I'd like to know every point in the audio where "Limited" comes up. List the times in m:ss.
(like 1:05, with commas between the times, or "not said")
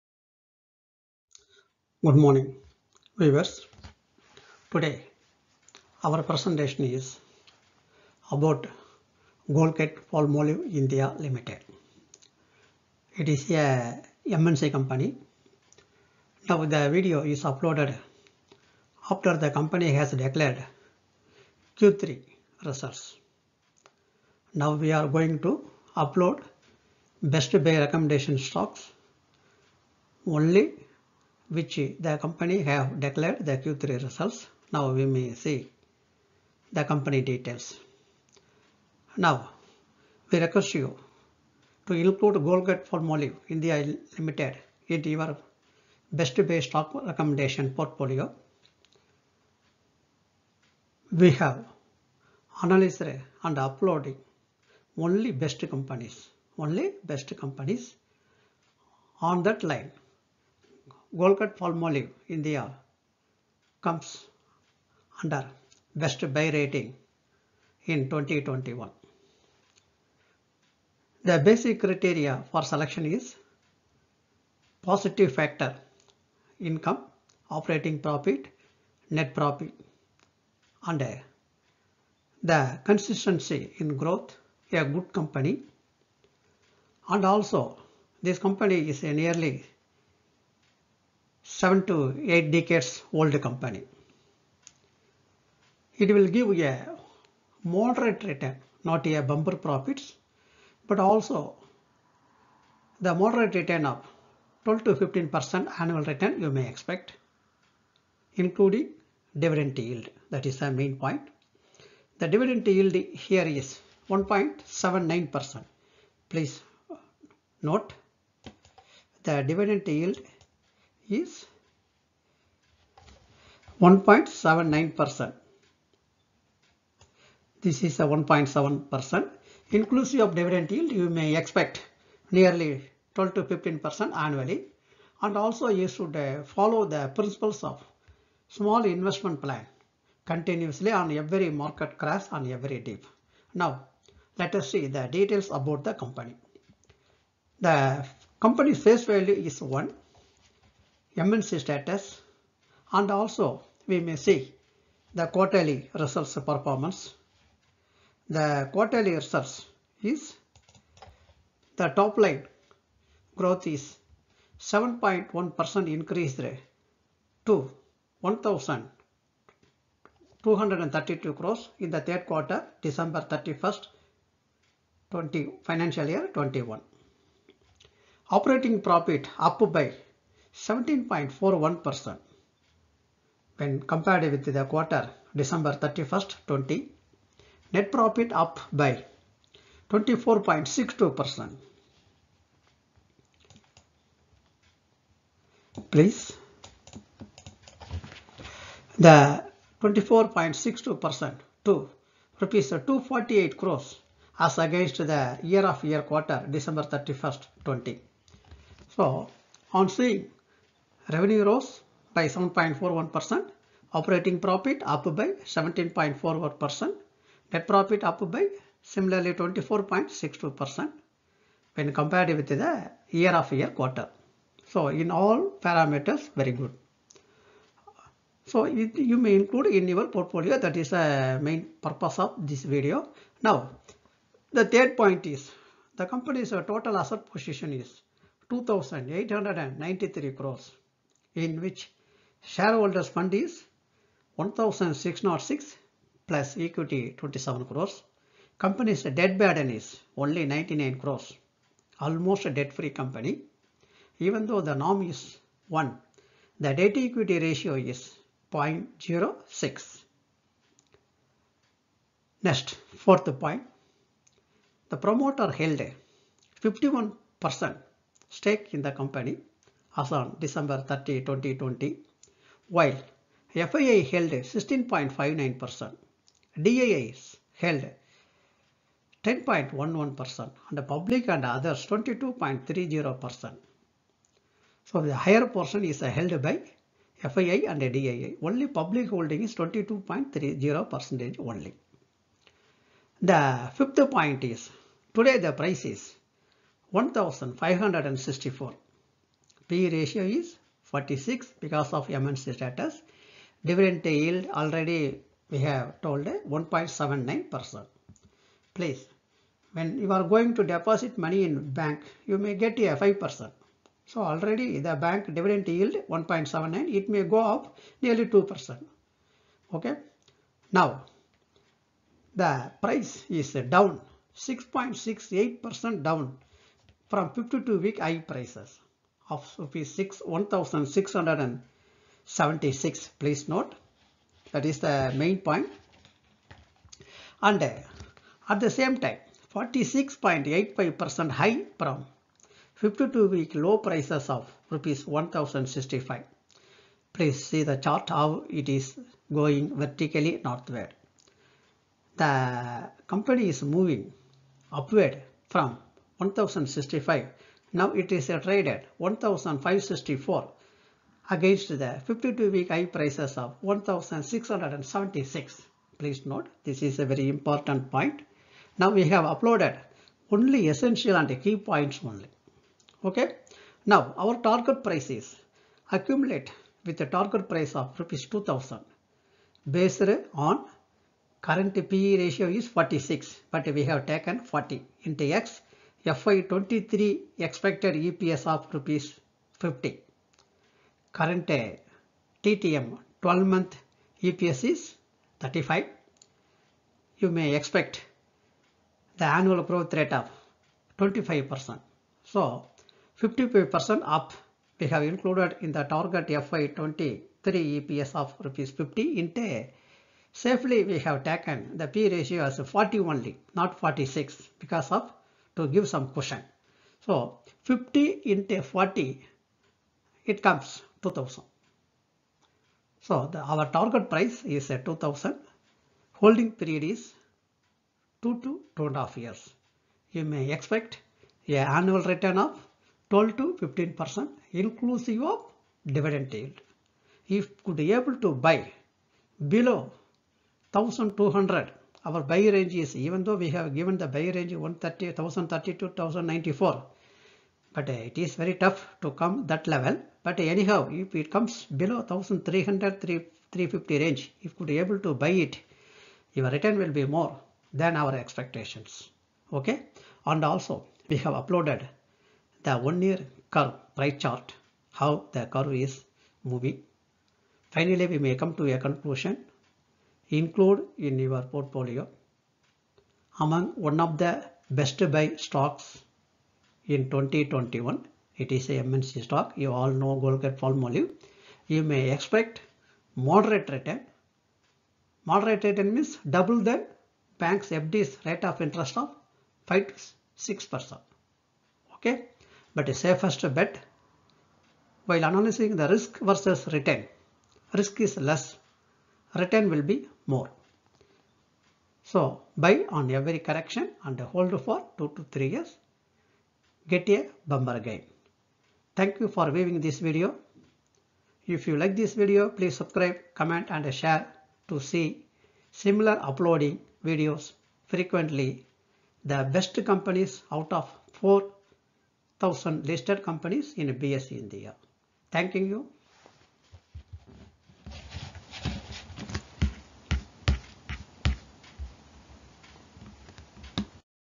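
0:11, 0:44.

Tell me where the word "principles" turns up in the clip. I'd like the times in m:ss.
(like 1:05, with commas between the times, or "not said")
2:17.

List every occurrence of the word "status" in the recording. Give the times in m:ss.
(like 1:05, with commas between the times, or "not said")
2:31, 5:02.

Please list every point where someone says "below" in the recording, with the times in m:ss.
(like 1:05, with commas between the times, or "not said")
7:19, 7:31.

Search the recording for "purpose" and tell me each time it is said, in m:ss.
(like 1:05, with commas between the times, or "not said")
3:51.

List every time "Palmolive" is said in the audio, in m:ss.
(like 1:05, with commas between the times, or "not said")
0:10, 0:42, 1:01, 8:00.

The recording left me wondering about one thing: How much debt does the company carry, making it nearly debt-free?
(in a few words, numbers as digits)
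99 crores.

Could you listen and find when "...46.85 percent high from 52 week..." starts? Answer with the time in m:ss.
5:39.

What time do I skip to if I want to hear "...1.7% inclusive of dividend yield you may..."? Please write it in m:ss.
2:08.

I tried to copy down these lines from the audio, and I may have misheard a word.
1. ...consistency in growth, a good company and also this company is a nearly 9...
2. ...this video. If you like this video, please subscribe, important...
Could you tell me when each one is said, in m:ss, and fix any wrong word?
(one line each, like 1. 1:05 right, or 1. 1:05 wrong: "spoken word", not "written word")
1. 1:22 wrong: "7", not "9"
2. 8:29 wrong: "comment", not "important".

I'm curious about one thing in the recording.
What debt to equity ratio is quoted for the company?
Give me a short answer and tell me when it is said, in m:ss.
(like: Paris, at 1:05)
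0.06, at 4:18.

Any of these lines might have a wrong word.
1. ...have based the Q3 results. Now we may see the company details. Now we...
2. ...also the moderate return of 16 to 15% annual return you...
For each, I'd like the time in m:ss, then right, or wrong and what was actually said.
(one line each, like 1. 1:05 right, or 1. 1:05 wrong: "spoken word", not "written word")
1. 0:32 wrong: "declared", not "based"
2. 1:40 wrong: "12", not "16".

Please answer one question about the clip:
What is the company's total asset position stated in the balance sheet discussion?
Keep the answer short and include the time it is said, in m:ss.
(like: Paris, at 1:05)
2893 crores, at 3:58.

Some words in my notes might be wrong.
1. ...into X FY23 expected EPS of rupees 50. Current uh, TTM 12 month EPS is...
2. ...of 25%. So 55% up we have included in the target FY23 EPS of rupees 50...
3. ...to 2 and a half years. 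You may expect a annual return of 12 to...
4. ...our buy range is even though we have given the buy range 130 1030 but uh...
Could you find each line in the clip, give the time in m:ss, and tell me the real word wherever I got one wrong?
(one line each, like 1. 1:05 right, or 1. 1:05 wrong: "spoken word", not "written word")
1. 6:25 right
2. 6:40 right
3. 7:08 right
4. 7:22 right.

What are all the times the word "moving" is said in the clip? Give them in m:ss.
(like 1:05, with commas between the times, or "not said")
5:53, 7:46.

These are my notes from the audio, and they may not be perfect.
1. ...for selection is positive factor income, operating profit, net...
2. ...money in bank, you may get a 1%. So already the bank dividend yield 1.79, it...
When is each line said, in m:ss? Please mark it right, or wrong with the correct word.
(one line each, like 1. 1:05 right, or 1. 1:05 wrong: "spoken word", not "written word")
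1. 1:12 right
2. 5:11 wrong: "5", not "1".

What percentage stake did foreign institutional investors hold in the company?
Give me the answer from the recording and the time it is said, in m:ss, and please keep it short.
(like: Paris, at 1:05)
16.59%, at 4:34.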